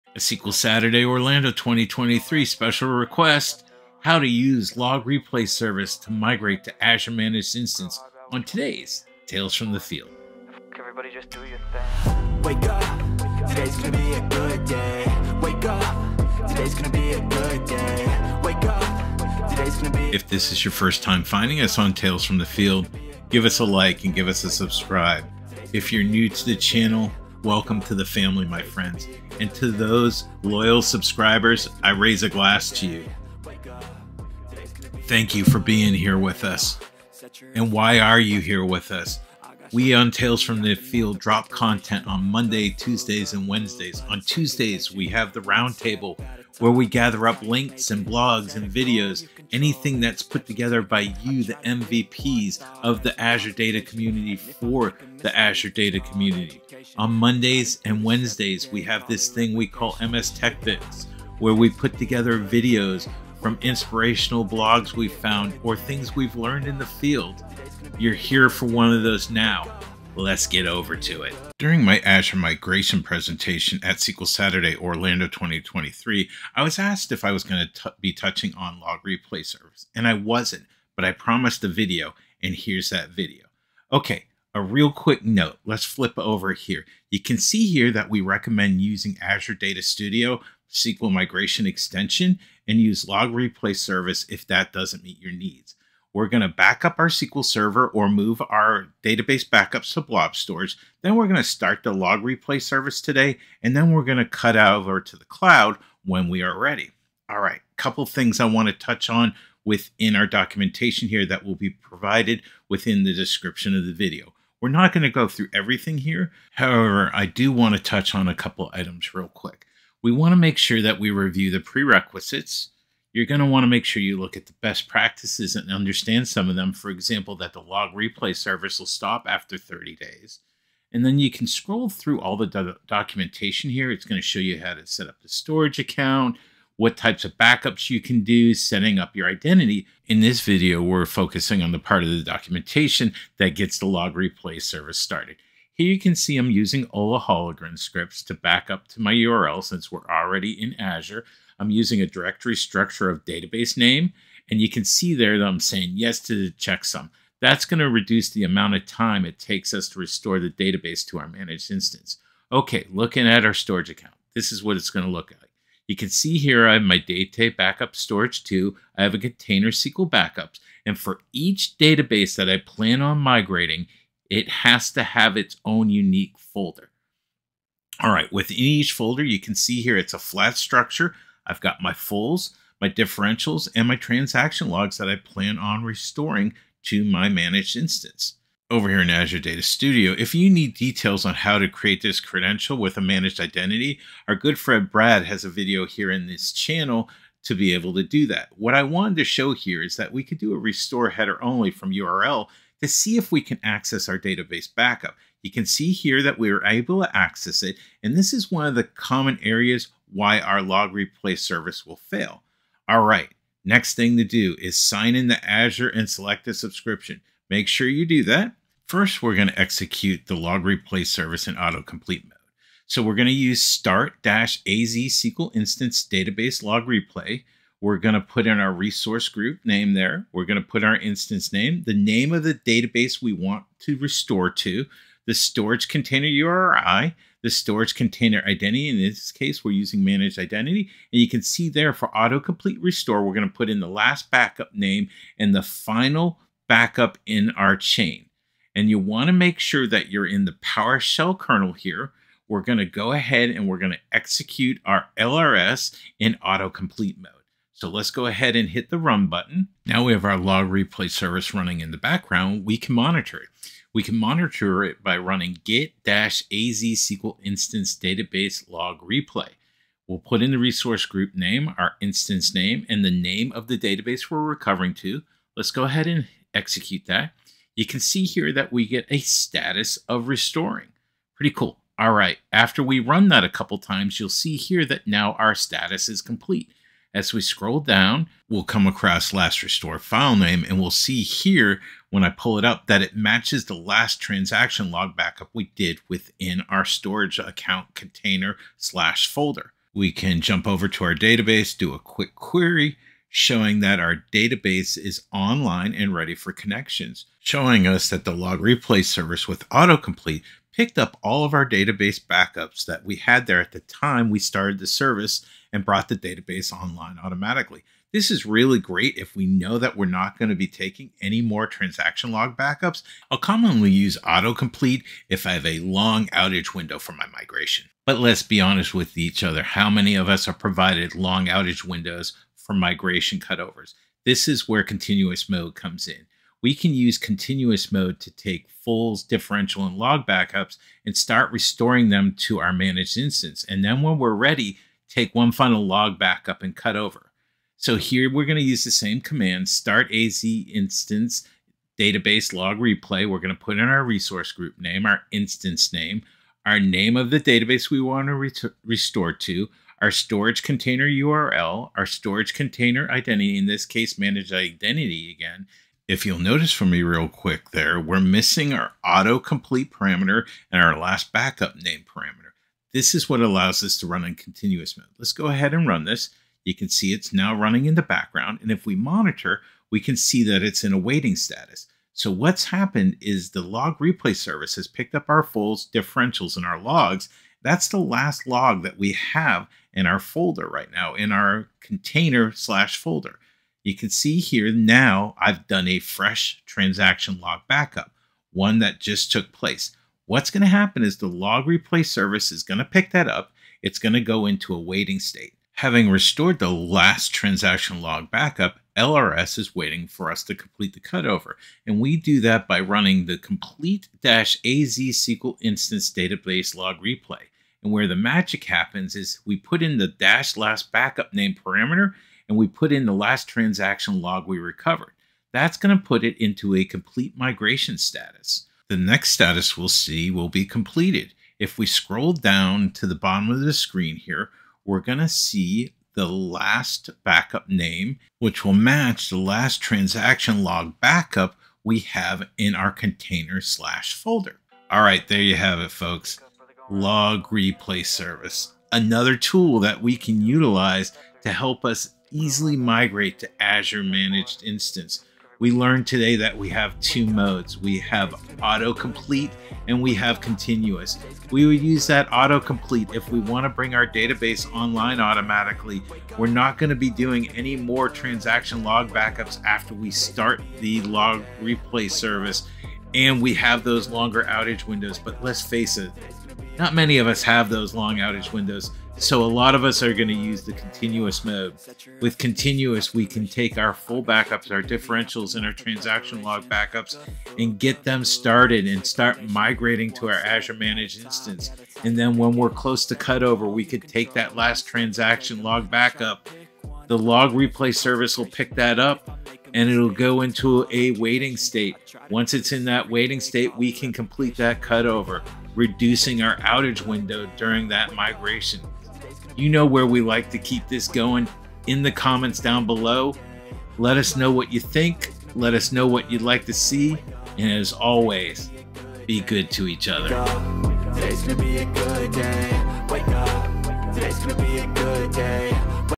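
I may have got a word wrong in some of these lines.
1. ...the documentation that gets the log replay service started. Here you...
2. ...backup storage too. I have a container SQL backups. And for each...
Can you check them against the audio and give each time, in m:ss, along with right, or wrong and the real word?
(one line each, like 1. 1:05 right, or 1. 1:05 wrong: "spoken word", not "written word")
1. 2:22 right
2. 2:47 right.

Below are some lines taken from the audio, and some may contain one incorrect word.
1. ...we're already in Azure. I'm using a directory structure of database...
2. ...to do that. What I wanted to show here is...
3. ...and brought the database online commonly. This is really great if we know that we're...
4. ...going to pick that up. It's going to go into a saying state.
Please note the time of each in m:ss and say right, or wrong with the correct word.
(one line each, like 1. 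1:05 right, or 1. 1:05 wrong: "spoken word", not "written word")
1. 2:29 right
2. 3:17 right
3. 5:15 wrong: "automatically", not "commonly"
4. 6:42 wrong: "waiting", not "saying".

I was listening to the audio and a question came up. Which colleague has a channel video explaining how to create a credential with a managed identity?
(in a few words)
Brad.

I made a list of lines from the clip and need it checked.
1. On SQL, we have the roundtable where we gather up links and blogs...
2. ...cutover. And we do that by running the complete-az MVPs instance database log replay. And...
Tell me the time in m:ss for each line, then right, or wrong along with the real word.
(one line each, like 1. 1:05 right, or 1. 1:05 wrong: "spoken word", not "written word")
1. 0:44 wrong: "Tuesdays", not "SQL"
2. 6:50 wrong: "SQL", not "MVPs".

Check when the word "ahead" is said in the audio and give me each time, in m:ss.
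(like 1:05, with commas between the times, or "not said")
4:13, 4:18, 4:35, 6:15.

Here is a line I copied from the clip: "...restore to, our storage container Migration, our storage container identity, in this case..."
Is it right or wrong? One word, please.
wrong.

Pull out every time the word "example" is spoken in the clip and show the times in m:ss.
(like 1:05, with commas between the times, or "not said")
2:06.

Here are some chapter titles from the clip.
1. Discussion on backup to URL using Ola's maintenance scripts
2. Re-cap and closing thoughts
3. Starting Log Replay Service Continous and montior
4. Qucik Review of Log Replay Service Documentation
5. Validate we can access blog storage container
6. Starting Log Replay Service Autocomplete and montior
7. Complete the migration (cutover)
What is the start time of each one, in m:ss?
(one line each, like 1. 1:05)
1. 2:21
2. 7:27
3. 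4:41
4. 1:12
5. 3:10
6. 3:31
7. 6:46.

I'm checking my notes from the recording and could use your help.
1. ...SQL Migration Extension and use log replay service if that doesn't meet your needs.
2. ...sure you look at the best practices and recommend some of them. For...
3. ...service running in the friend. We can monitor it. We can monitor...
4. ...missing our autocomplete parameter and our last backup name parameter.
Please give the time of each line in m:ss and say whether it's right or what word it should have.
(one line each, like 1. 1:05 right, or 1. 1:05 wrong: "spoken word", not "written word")
1. 1:30 right
2. 2:03 wrong: "understand", not "recommend"
3. 4:21 wrong: "background", not "friend"
4. 6:08 right.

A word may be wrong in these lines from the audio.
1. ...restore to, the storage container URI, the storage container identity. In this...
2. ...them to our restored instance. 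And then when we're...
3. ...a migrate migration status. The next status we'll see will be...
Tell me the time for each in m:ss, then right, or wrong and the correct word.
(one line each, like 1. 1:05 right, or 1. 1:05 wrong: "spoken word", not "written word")
1. 3:53 right
2. 5:42 wrong: "managed", not "restored"
3. 7:06 wrong: "complete", not "migrate".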